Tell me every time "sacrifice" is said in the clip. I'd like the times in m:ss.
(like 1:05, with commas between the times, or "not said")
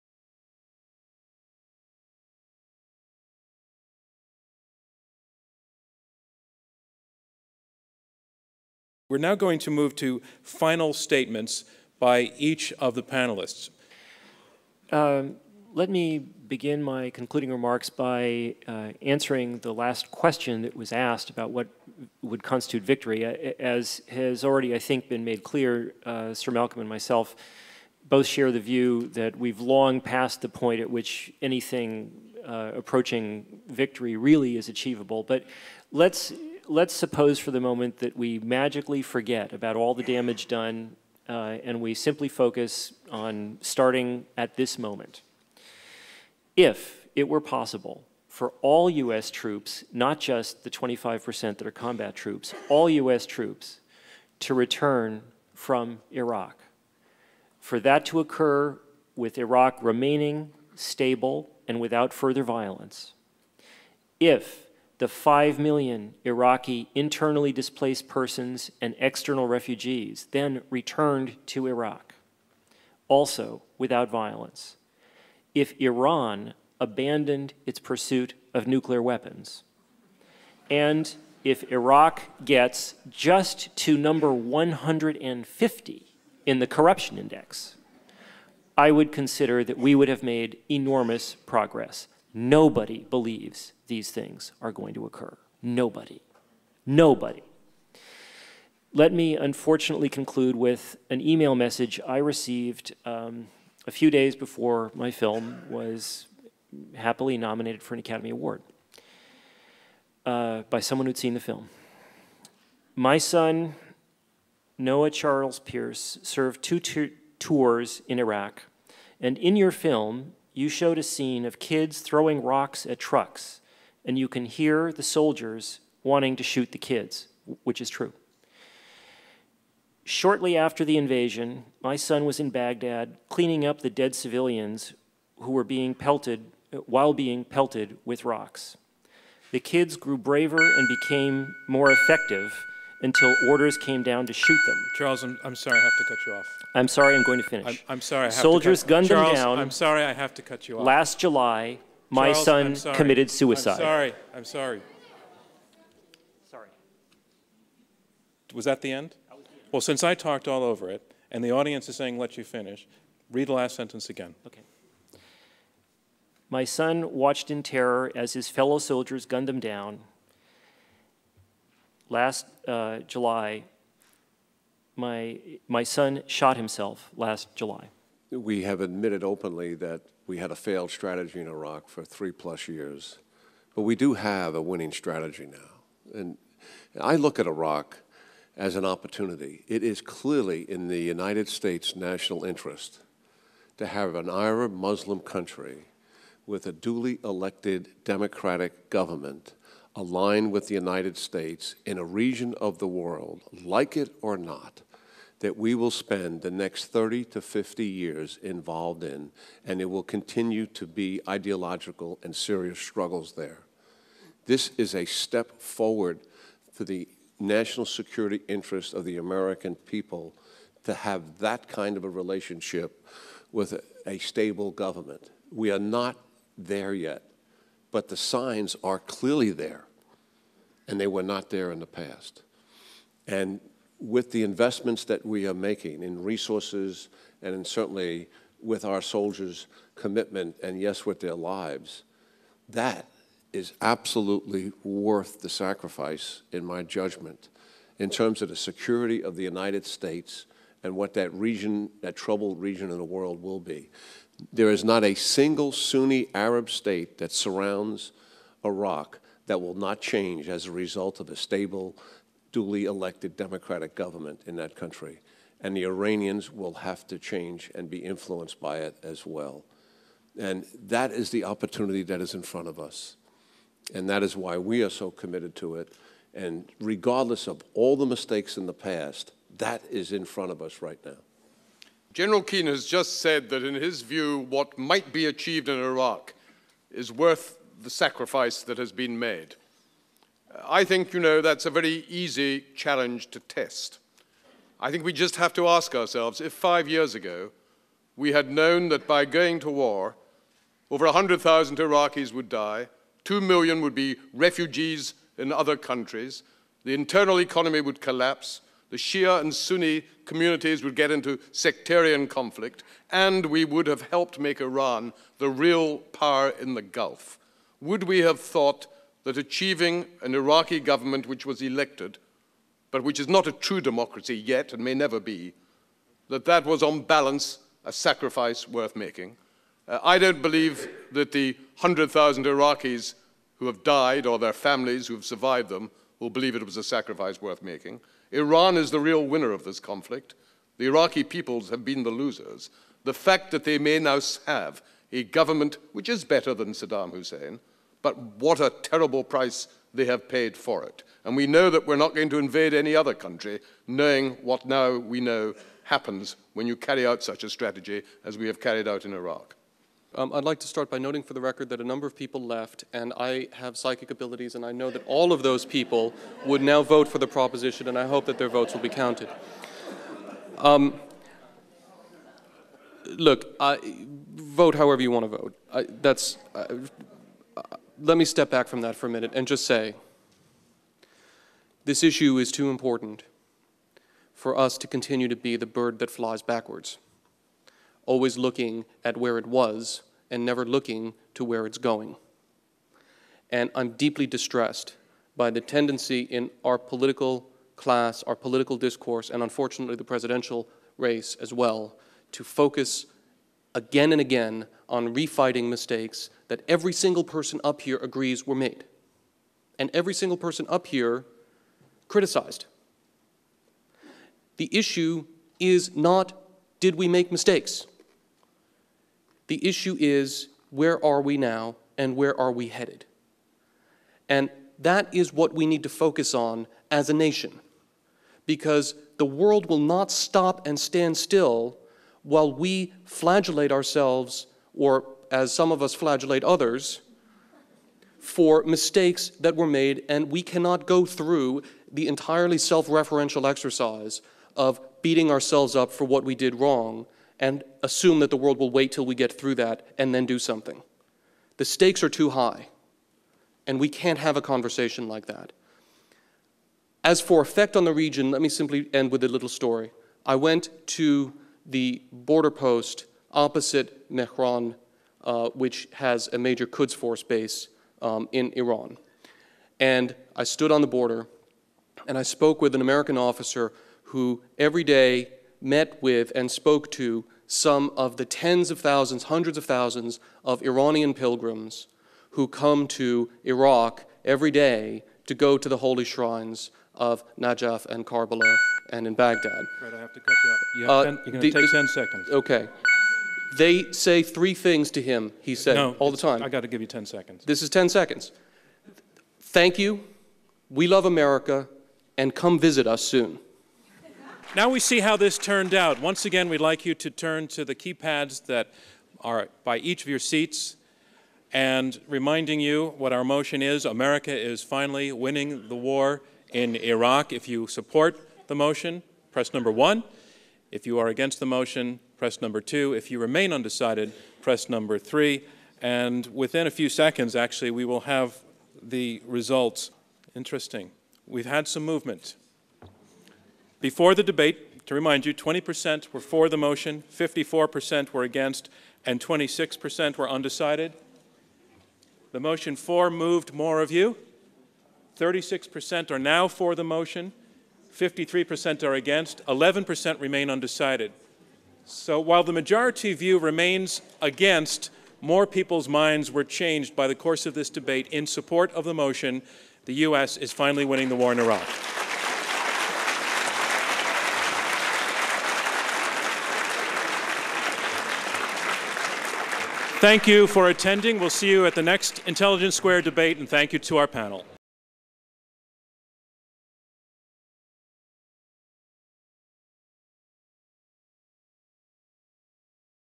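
4:05, 4:47, 5:27, 5:36.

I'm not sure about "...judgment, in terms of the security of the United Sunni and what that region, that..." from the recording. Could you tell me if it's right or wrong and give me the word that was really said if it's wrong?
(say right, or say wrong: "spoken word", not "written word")
wrong: "States", not "Sunni".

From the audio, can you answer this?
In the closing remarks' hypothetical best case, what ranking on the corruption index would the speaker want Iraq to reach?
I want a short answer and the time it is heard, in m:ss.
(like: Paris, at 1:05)
150, at 1:24.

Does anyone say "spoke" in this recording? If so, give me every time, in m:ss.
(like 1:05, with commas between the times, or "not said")
7:52, 7:56.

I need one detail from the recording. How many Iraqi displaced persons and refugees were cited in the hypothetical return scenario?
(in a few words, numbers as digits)
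5 million.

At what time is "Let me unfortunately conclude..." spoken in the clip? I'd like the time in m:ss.
1:38.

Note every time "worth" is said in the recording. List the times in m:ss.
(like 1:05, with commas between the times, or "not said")
4:04, 4:47, 5:28, 5:37.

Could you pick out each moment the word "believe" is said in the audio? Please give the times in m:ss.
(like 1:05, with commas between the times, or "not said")
1:33, 5:30, 5:36.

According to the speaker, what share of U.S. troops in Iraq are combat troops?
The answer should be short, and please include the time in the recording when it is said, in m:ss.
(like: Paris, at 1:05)
25%, at 0:50.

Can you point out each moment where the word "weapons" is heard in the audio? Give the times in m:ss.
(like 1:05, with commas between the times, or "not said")
1:19.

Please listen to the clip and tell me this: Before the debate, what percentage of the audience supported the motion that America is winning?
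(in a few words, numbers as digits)
20%.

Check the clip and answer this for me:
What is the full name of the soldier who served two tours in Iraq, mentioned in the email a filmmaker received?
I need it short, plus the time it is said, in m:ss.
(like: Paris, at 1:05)
Noah Charles Pierce, at 1:54.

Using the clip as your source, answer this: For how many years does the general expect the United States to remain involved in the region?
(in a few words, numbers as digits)
30 to 50 years.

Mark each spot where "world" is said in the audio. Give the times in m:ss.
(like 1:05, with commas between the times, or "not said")
3:22, 4:13, 7:09, 7:28.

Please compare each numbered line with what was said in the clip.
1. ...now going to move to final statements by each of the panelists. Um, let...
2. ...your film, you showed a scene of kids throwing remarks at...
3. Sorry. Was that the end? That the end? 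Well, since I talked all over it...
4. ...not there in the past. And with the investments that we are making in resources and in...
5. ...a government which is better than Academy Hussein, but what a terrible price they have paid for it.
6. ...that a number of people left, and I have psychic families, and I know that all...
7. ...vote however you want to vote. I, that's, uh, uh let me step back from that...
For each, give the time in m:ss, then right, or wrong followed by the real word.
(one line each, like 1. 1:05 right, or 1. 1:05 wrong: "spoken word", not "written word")
1. 0:09 right
2. 1:59 wrong: "rocks", not "remarks"
3. 2:36 right
4. 3:51 right
5. 5:45 wrong: "Saddam", not "Academy"
6. 6:01 wrong: "abilities", not "families"
7. 6:14 right.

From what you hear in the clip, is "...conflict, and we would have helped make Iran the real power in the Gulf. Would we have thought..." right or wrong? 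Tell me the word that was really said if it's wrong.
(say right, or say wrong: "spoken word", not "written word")
right.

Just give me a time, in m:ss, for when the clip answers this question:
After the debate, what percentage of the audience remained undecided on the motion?
9:09.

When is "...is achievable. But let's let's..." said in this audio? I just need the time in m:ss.
0:34.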